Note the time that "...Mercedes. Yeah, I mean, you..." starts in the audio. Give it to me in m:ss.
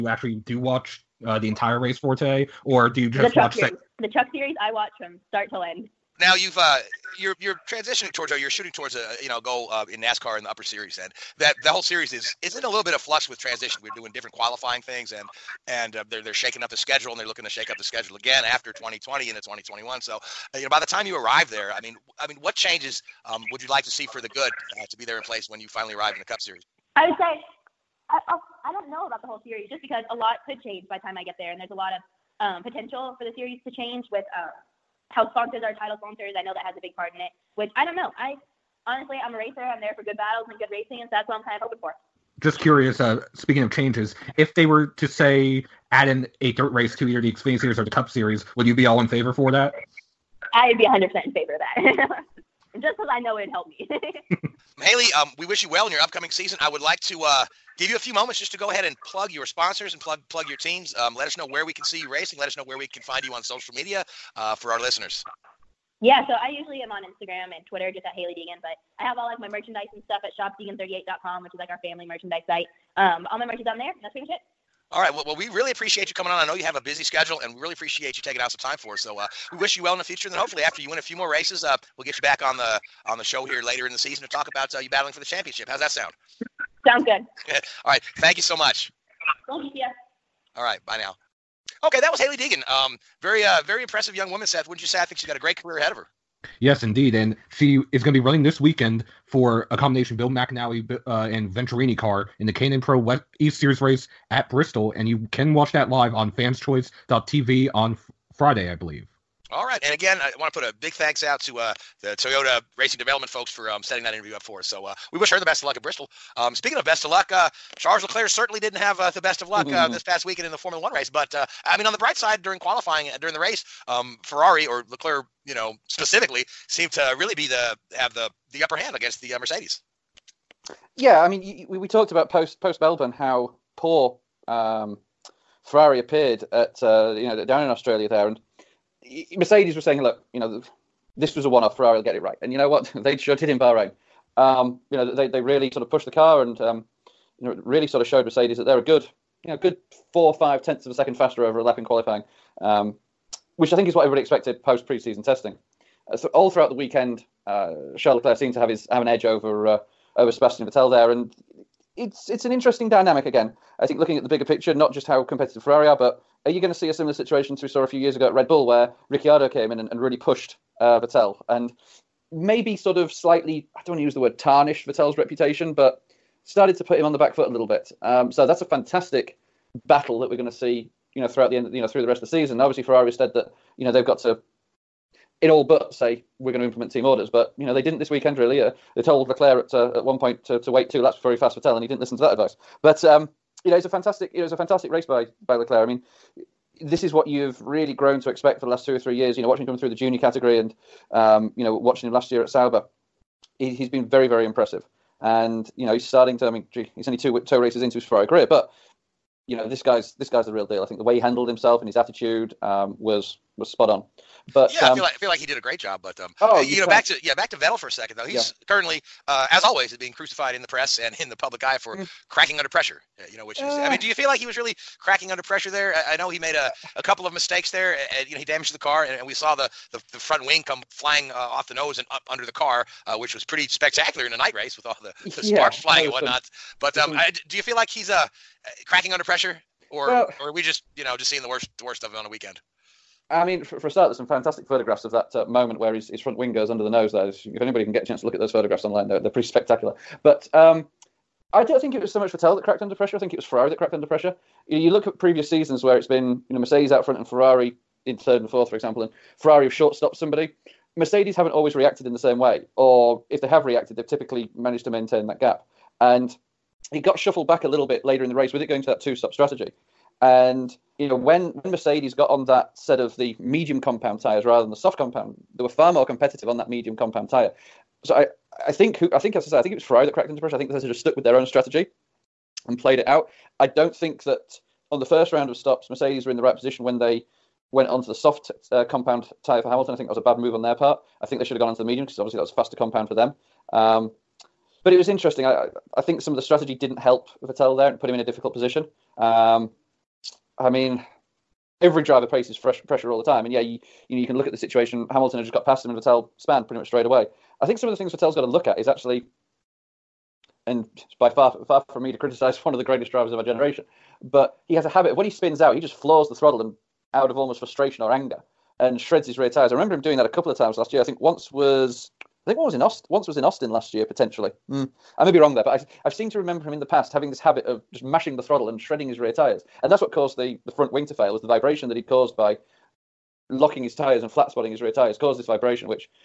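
2:09.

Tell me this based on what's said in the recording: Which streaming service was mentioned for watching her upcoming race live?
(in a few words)
fanschoice.tv.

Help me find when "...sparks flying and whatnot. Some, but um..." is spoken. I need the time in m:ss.
3:55.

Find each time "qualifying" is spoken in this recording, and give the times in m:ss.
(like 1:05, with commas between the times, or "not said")
0:14, 2:02, 2:31.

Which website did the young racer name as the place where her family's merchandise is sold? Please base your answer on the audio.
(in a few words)
shopdeegan38.com.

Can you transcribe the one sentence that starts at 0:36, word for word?
I know that has a big part in it, which I don't know.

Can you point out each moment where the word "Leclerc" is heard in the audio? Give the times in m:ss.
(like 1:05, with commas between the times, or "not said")
1:58, 2:04, 2:38, 3:09, 3:15.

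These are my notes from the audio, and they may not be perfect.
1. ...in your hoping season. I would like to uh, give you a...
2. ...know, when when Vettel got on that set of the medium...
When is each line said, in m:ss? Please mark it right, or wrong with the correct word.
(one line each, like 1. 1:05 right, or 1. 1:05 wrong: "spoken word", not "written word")
1. 0:55 wrong: "upcoming", not "hoping"
2. 4:31 wrong: "Mercedes", not "Vettel".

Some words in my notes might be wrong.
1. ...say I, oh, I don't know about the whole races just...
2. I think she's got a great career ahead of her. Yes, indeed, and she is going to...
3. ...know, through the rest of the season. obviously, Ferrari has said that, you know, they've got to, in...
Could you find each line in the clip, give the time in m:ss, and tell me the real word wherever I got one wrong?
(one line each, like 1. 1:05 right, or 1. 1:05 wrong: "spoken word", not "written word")
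1. 0:27 wrong: "series", not "races"
2. 1:35 right
3. 3:01 right.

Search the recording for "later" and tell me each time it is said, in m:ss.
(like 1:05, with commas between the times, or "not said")
1:23, 4:28.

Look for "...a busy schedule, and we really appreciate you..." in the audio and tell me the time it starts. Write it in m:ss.
1:16.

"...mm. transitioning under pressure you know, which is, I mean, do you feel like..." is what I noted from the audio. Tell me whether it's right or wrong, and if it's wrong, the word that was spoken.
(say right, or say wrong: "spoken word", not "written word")
wrong: "cracking", not "transitioning".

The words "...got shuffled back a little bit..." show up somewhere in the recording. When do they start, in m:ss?
4:27.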